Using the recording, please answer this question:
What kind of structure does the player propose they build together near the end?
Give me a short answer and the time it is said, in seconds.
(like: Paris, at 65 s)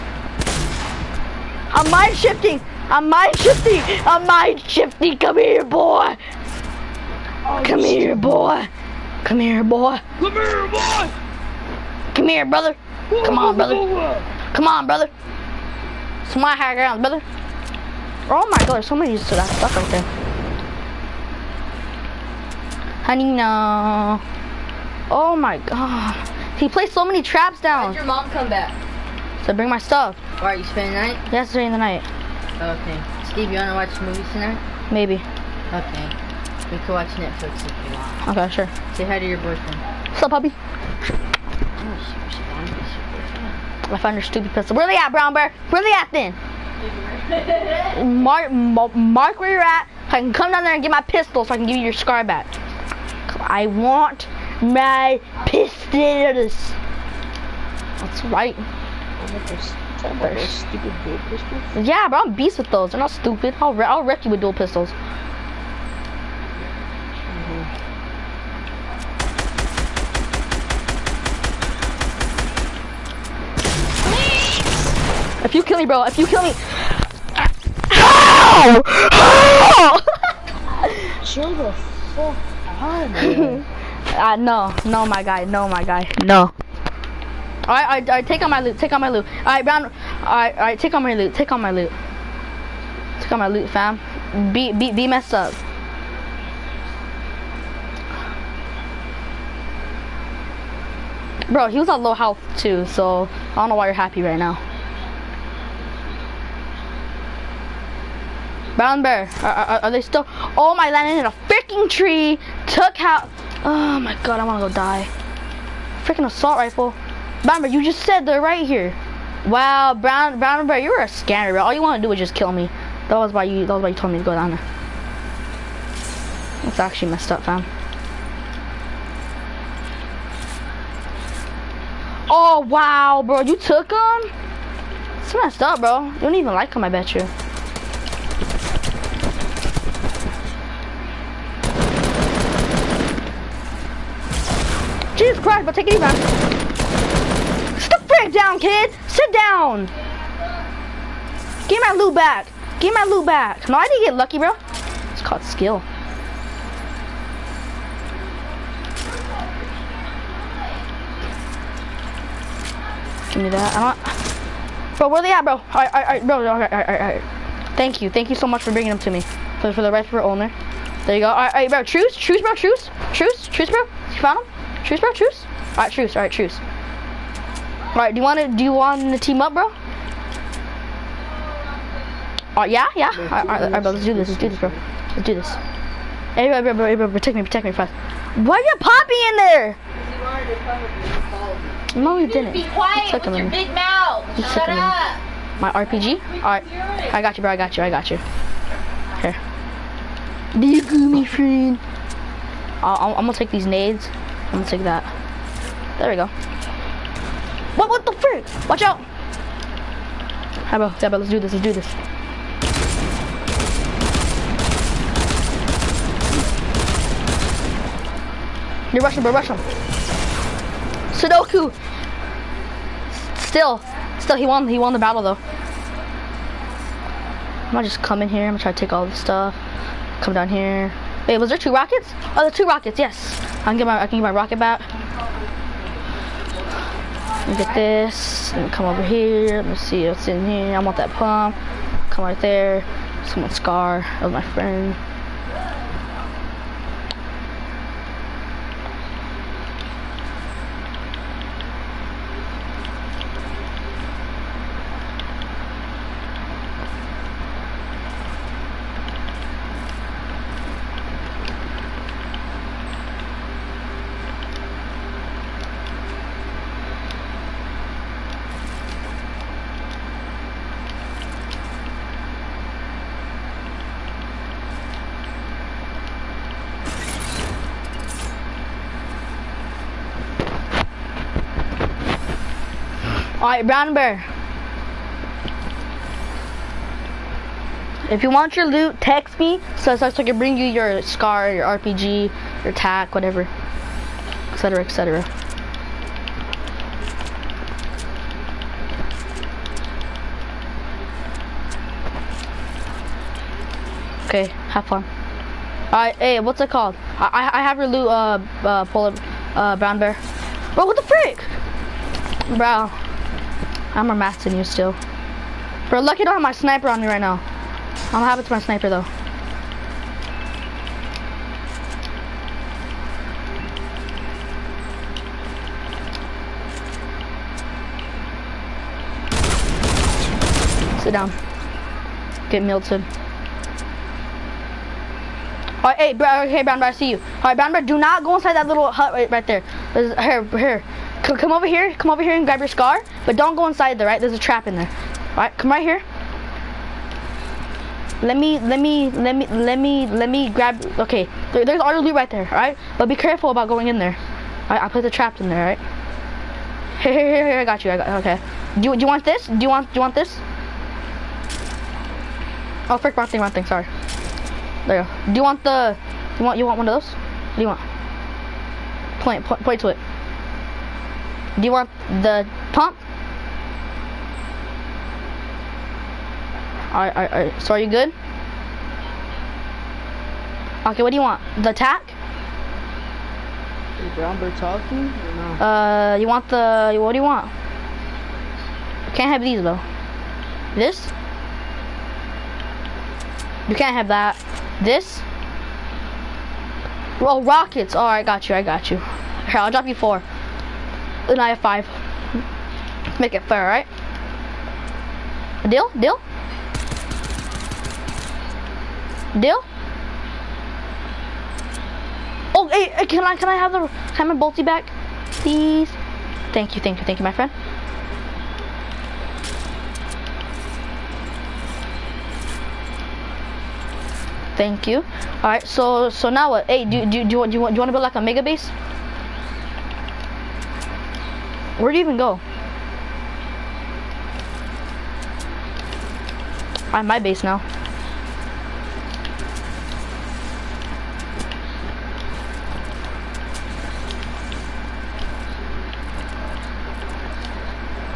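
A mega base, at 428 s.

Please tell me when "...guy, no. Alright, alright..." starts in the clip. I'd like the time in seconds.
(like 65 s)
85 s.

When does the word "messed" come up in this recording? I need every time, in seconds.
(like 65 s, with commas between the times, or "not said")
95 s, 127 s, 135 s.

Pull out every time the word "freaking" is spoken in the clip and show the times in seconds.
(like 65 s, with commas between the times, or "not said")
111 s, 116 s.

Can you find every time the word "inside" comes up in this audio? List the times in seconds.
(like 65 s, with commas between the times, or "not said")
338 s, 343 s.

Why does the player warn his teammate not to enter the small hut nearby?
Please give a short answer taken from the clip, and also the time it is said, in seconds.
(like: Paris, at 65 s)
A trap, at 344 s.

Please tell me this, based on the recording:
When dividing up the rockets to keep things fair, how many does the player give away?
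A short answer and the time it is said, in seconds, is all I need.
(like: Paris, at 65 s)
4, at 399 s.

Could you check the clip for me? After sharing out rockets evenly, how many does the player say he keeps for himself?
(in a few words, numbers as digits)
5.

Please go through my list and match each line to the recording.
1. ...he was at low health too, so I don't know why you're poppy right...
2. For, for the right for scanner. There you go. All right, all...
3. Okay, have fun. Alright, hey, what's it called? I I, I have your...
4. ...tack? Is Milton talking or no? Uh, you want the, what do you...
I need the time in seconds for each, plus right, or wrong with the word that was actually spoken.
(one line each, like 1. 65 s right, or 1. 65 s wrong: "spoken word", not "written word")
1. 101 s wrong: "happy", not "poppy"
2. 169 s wrong: "owner", not "scanner"
3. 304 s right
4. 381 s wrong: "Robert", not "Milton".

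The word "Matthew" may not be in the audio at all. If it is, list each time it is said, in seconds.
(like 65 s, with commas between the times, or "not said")
not said.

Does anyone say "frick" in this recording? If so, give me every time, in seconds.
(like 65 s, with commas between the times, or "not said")
208 s, 311 s, 362 s.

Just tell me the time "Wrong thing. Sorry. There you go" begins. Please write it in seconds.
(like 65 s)
363 s.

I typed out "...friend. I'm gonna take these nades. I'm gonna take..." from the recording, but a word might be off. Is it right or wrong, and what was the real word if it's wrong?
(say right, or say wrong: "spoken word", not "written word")
right.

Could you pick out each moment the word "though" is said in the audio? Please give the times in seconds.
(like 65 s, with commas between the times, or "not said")
225 s, 318 s, 389 s.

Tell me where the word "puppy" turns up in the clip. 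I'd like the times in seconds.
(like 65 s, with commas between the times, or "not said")
40 s.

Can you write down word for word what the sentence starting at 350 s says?
Okay, there, there's auto your loot right there.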